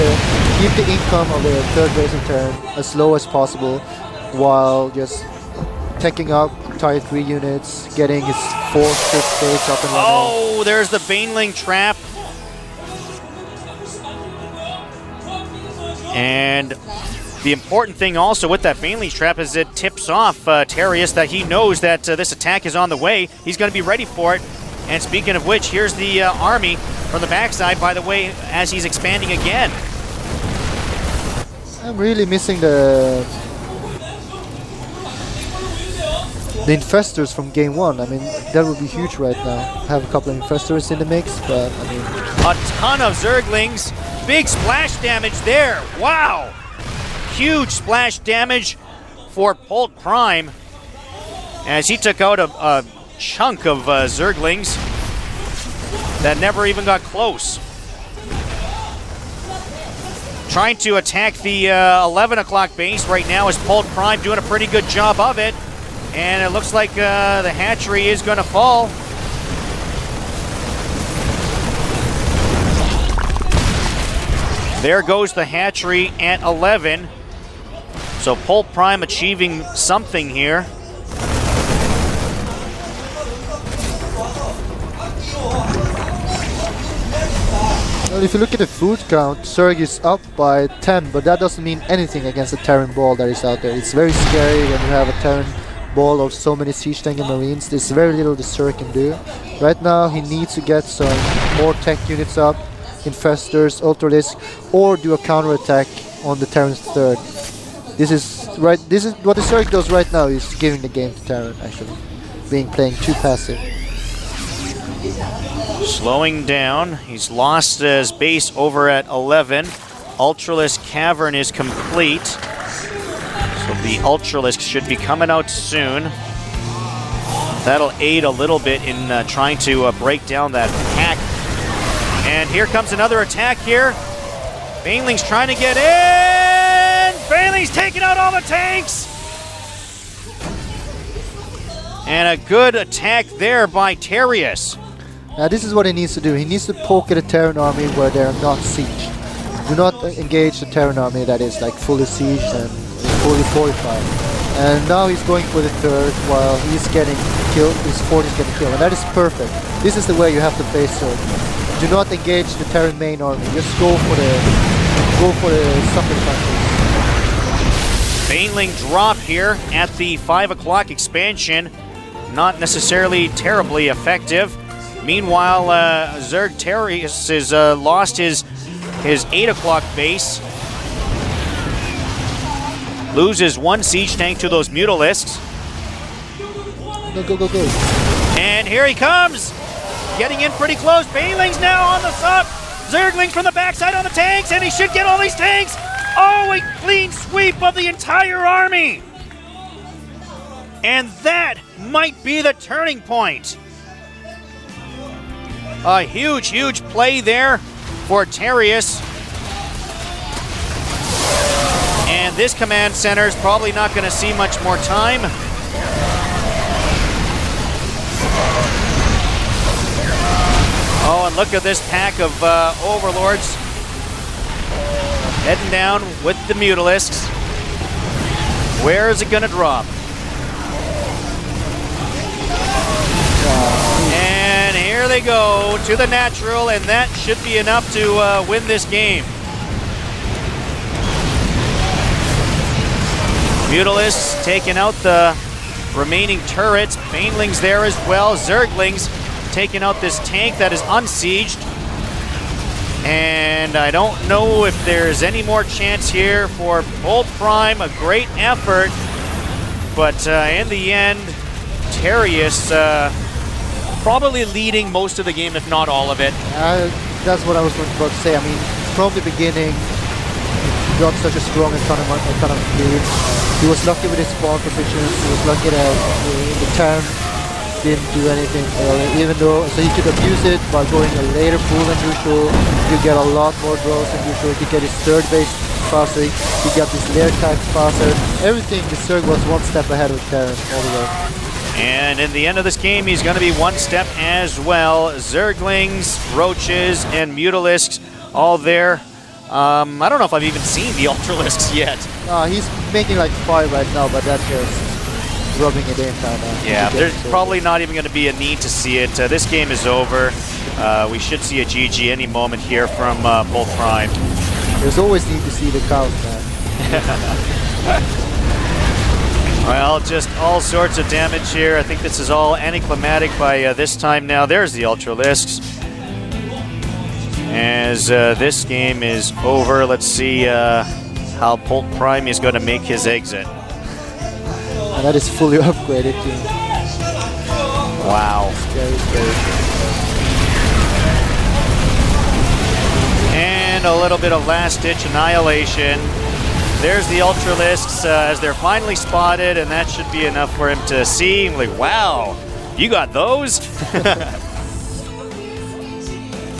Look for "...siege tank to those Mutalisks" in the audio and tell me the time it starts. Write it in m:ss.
3:03.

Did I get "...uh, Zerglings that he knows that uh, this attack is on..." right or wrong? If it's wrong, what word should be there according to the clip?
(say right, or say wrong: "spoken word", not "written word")
wrong: "Terious", not "Zerglings".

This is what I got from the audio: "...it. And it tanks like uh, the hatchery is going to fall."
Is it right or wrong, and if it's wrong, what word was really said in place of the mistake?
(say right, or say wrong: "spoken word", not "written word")
wrong: "looks", not "tanks".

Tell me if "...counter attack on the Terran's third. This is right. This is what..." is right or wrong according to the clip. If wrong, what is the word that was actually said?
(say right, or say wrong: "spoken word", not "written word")
right.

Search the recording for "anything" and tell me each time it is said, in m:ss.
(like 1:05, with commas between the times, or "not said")
1:31, 4:38.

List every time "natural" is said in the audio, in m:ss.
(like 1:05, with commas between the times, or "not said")
3:56.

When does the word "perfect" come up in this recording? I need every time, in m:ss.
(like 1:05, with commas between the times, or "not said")
2:39.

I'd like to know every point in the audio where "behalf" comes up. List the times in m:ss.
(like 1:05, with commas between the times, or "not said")
not said.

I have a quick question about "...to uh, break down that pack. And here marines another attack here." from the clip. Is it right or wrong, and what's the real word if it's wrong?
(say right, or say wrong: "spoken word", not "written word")
wrong: "comes", not "marines".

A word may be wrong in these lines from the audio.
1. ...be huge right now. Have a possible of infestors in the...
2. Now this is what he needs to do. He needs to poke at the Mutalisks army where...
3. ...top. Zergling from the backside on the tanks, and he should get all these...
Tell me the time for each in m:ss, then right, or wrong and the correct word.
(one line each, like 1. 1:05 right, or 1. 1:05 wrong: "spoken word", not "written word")
1. 0:38 wrong: "couple", not "possible"
2. 2:25 wrong: "Terran", not "Mutalisks"
3. 3:12 right.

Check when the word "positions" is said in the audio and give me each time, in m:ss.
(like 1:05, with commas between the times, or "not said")
4:34.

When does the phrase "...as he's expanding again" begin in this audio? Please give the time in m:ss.
0:28.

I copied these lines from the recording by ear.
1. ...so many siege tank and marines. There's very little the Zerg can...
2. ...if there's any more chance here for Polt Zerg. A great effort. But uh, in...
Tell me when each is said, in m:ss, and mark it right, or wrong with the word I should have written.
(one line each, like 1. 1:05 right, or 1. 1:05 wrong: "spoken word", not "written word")
1. 1:36 right
2. 4:14 wrong: "Prime", not "Zerg".